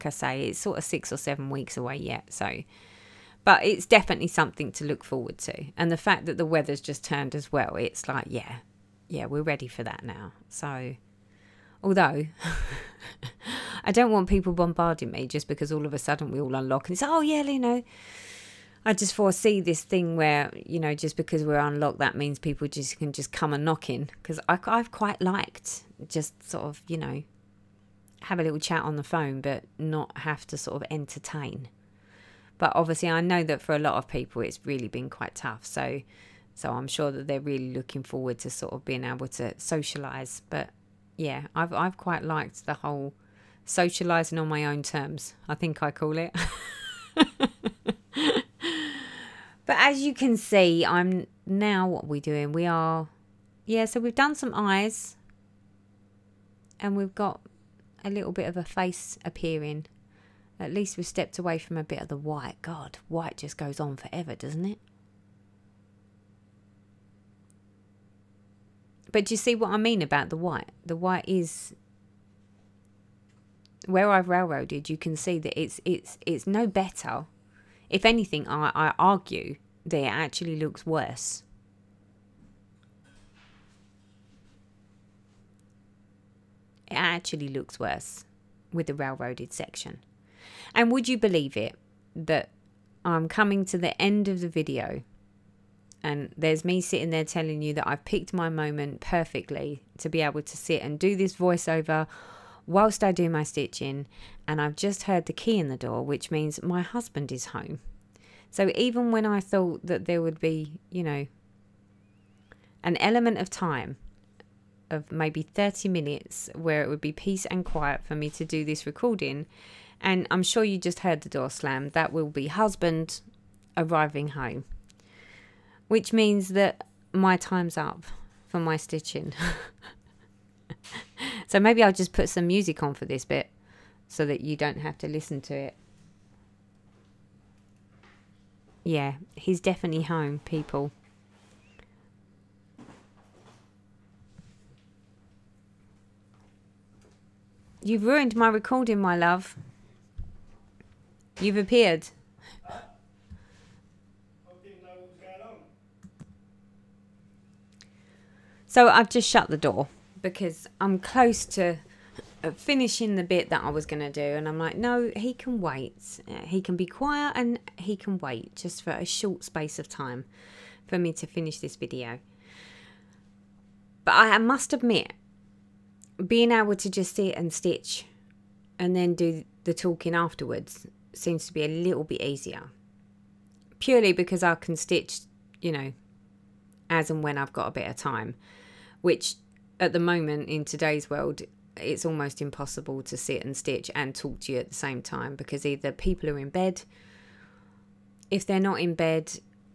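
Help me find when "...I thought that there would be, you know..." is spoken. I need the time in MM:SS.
01:49.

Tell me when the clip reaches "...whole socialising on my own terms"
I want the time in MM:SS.
00:42.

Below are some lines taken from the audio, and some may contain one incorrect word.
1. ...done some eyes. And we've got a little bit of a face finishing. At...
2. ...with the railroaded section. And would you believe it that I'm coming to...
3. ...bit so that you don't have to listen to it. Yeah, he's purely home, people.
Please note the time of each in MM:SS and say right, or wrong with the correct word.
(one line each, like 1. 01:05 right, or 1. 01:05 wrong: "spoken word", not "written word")
1. 00:54 wrong: "appearing", not "finishing"
2. 01:28 right
3. 02:13 wrong: "definitely", not "purely".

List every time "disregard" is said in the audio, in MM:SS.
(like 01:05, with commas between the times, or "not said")
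not said.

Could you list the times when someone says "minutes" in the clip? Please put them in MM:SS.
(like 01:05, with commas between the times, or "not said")
01:55.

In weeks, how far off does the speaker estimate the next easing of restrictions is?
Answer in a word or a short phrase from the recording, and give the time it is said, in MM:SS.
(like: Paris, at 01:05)
6 or 7 weeks, at 00:00.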